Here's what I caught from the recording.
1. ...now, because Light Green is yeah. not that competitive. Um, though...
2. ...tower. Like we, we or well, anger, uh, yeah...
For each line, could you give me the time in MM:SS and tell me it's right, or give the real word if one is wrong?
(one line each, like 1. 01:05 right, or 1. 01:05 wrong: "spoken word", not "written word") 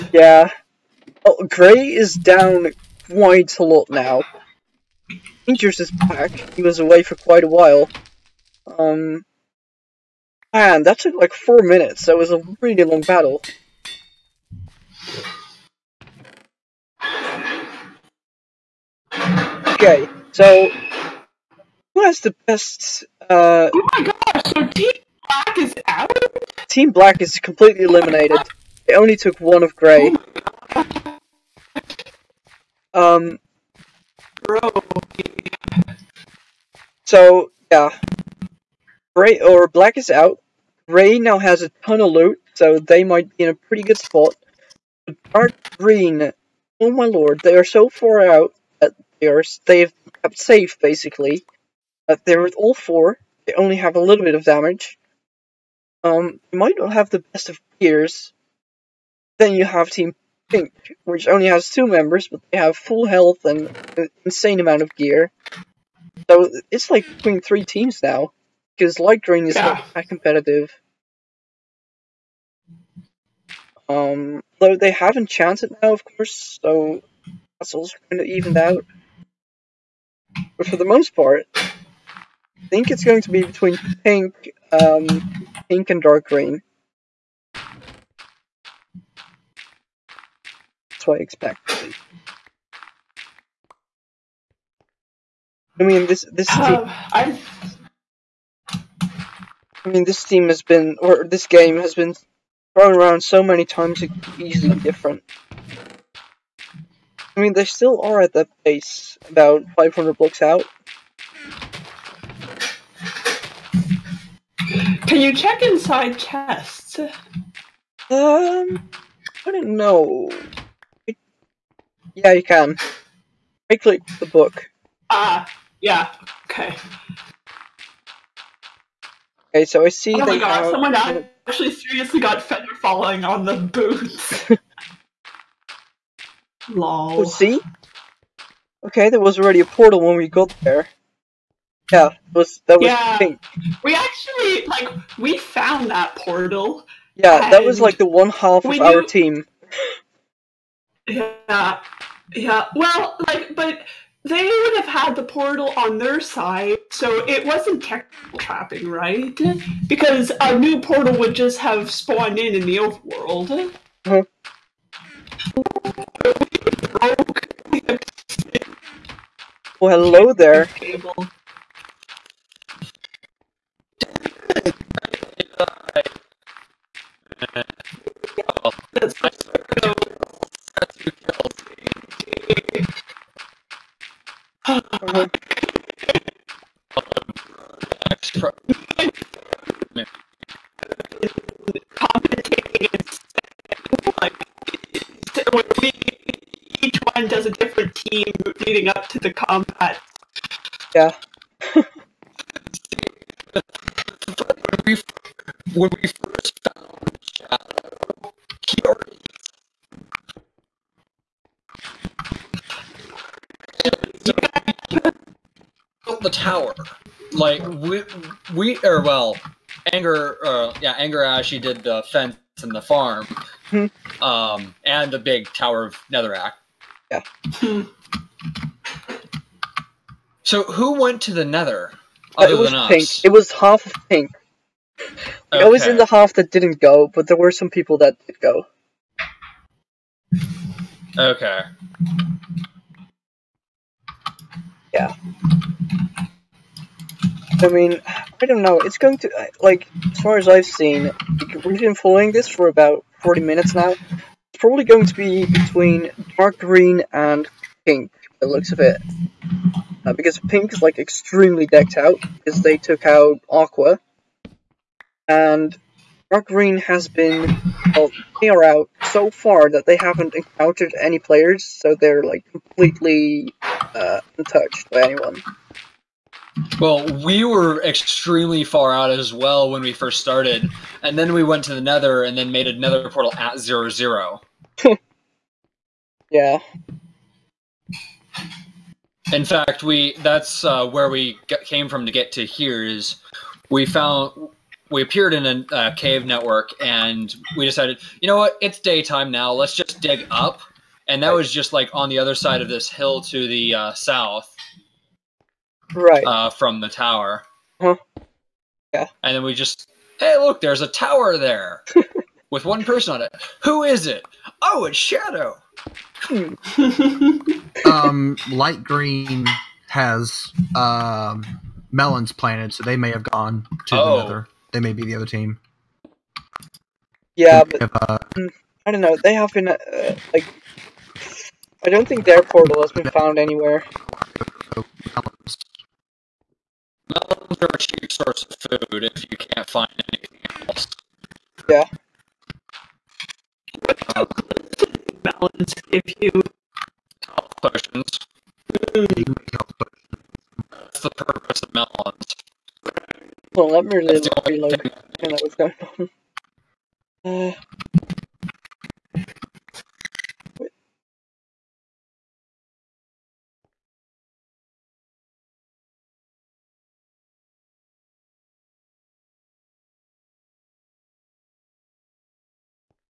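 1. 01:08 right
2. 03:36 right.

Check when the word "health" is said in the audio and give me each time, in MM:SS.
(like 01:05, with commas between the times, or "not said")
01:03, 05:47.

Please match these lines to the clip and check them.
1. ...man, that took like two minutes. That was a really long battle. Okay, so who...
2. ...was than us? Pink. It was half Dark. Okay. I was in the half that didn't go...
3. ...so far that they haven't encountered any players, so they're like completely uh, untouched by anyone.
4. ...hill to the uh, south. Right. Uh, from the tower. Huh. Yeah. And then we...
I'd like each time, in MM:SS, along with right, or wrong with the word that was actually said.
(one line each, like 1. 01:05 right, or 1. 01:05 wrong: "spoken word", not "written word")
1. 00:10 wrong: "four", not "two"
2. 03:52 wrong: "Pink", not "Dark"
3. 04:29 right
4. 05:02 right.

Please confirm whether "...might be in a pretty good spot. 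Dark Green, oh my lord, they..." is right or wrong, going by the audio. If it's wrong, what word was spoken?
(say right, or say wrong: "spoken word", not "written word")
right.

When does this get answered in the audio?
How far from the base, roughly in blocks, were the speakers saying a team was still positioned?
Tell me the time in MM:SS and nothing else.
01:49.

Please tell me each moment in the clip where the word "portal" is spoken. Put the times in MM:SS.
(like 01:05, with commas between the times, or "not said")
02:19, 02:26, 02:35, 02:40, 04:43, 05:32.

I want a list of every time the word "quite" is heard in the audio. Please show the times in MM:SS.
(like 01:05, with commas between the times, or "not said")
00:03, 00:07.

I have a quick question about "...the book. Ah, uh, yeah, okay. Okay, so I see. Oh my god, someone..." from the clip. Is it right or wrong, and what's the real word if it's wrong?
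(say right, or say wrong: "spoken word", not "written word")
right.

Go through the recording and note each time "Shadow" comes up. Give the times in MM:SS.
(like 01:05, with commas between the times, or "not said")
03:27, 05:14.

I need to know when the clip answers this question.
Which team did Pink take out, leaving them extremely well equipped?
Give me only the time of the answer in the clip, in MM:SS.
04:23.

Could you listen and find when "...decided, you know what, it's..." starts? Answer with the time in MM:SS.
04:57.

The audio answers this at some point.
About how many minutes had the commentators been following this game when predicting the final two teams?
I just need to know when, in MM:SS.
04:13.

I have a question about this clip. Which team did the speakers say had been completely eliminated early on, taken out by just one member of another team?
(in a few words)
Team Black.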